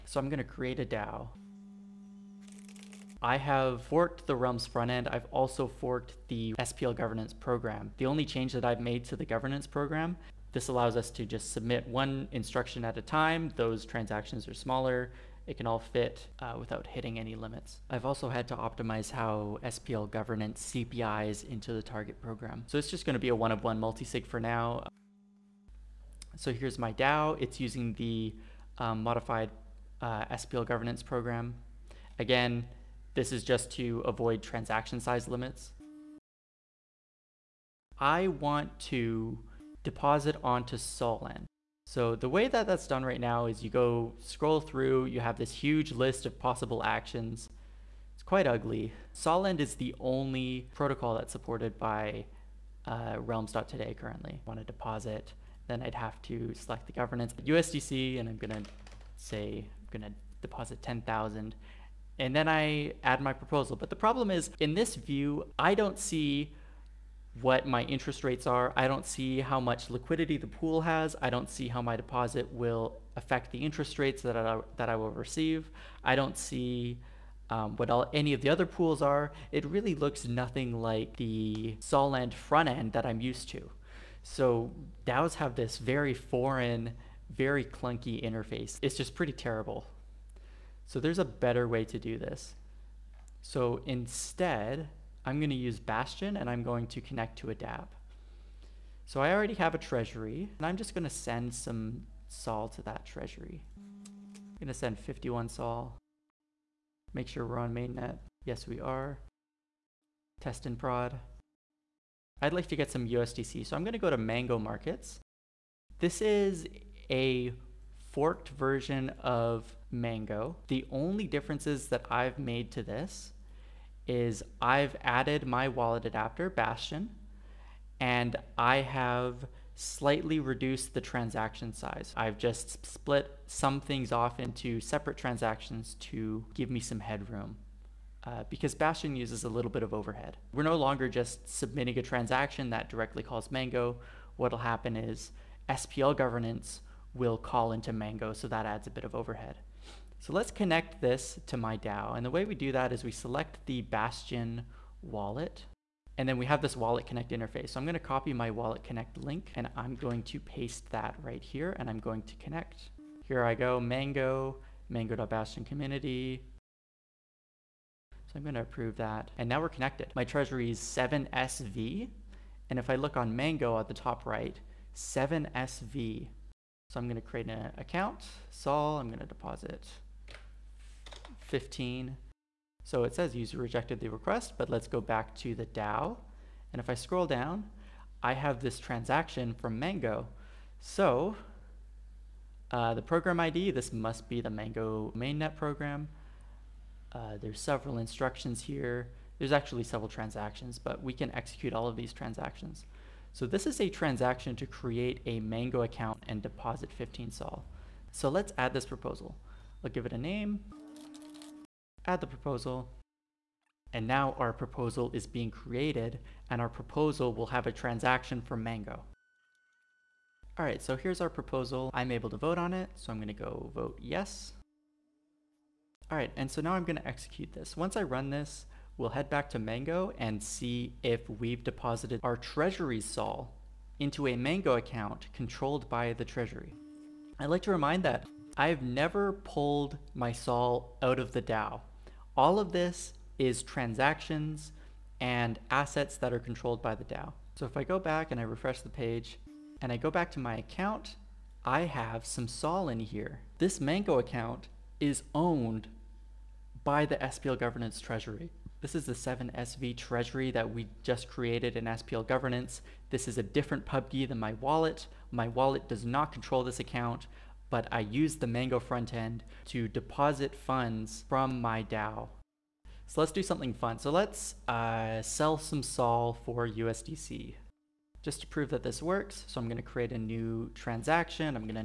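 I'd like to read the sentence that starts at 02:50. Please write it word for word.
My treasury is 7SV, and if I look on Mango at the top right, 7SV.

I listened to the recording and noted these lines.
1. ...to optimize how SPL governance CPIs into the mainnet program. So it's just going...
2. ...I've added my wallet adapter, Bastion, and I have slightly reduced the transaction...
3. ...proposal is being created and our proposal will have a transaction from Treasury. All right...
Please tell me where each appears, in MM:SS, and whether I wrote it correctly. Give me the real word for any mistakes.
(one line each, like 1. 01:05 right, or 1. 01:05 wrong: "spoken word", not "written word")
1. 00:18 wrong: "target", not "mainnet"
2. 02:04 right
3. 03:34 wrong: "Mango", not "Treasury".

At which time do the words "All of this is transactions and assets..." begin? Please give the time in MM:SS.
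04:02.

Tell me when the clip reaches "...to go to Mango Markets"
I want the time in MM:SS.
01:53.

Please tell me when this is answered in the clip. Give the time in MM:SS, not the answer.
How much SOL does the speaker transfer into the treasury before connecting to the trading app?
01:44.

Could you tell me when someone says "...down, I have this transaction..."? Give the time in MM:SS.
03:07.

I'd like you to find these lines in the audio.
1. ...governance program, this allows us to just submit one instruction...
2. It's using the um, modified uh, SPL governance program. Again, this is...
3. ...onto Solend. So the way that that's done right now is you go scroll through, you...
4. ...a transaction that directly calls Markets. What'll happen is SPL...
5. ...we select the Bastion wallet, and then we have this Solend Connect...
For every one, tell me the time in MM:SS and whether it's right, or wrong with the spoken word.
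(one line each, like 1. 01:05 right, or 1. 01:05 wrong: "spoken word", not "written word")
1. 00:09 right
2. 00:27 right
3. 00:40 right
4. 02:21 wrong: "Mango", not "Markets"
5. 02:33 wrong: "Wallet", not "Solend".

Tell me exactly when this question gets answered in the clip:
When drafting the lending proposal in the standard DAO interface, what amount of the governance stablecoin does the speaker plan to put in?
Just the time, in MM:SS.
01:00.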